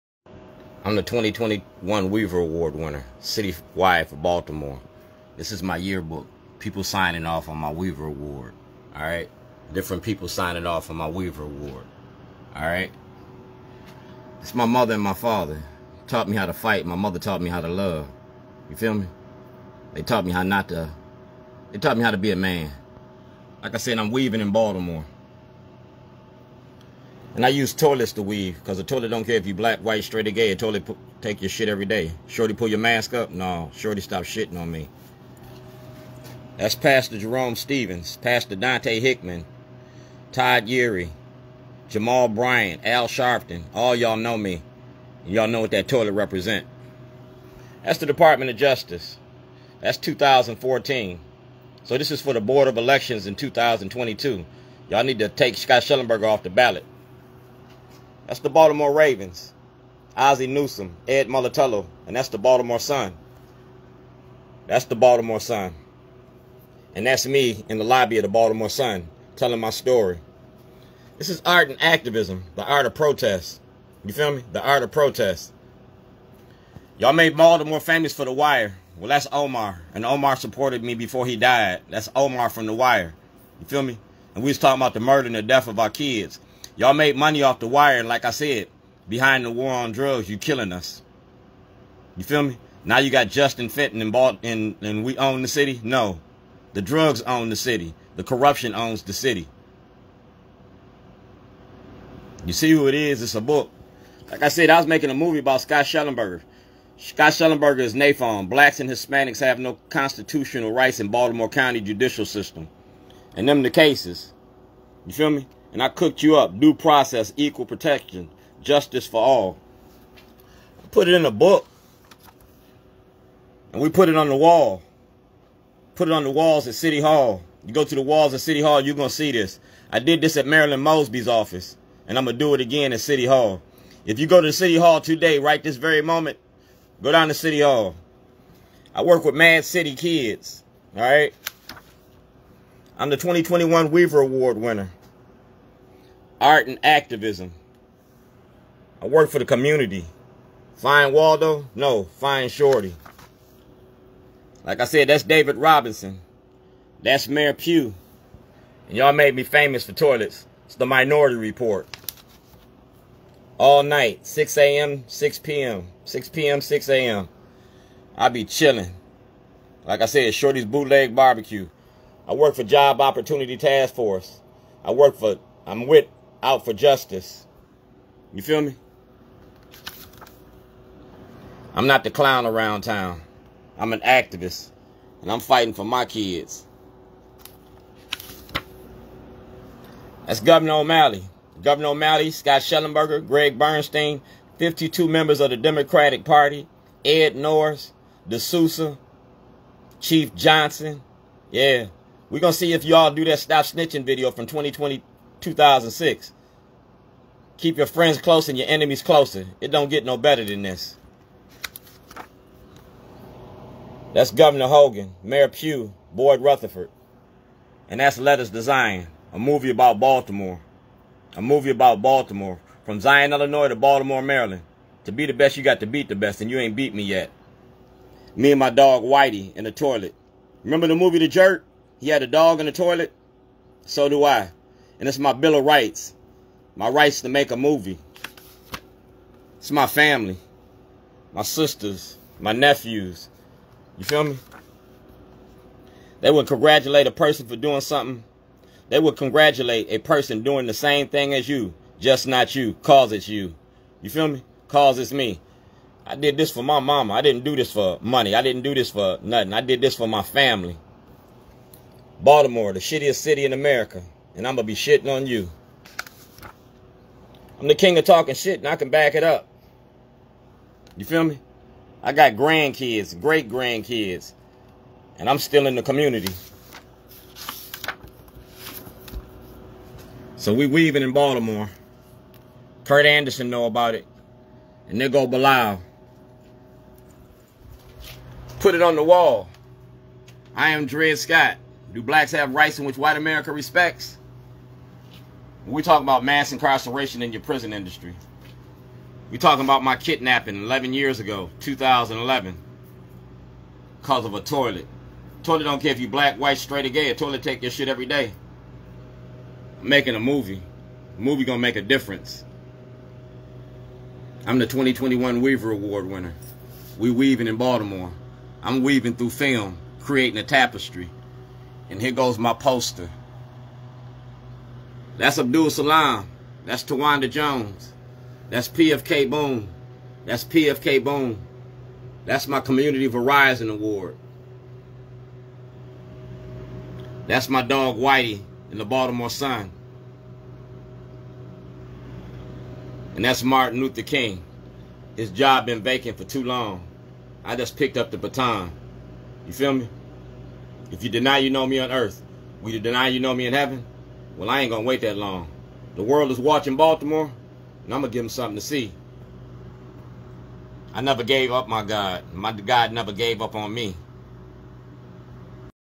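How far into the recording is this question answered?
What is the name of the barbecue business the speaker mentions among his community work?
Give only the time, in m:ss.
2:50.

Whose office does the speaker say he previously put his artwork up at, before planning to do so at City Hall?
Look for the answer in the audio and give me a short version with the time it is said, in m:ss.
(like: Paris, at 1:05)
Marilyn Mosby, at 2:10.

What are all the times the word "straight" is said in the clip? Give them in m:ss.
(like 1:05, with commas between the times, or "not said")
0:30, 5:06.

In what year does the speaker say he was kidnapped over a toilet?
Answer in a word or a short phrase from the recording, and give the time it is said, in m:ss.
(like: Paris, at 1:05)
2011, at 5:01.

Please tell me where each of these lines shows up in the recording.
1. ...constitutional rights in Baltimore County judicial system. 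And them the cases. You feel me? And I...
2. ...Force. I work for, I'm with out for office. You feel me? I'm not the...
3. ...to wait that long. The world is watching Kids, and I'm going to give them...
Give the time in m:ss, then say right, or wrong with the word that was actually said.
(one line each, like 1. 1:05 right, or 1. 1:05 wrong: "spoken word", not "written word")
1. 1:49 right
2. 2:53 wrong: "justice", not "office"
3. 5:54 wrong: "Baltimore", not "Kids".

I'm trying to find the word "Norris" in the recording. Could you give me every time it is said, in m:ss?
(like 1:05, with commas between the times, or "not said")
3:17.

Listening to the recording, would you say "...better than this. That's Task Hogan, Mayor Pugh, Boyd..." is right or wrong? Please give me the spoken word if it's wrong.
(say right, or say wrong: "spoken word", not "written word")
wrong: "Governor", not "Task".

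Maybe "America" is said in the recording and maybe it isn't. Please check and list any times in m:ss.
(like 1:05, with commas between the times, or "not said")
4:23, 4:53.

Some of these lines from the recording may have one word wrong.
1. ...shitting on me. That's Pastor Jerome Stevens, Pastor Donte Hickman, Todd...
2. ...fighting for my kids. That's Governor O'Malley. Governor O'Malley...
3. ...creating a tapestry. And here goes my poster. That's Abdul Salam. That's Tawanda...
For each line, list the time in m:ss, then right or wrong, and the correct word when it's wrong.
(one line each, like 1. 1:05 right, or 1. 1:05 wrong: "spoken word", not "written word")
1. 0:34 right
2. 3:05 right
3. 5:20 right.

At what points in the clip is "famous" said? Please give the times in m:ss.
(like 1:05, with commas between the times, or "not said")
1:17, 2:39.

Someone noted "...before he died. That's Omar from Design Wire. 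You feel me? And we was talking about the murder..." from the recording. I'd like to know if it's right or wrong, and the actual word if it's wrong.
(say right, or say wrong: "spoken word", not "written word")
wrong: "The", not "Design".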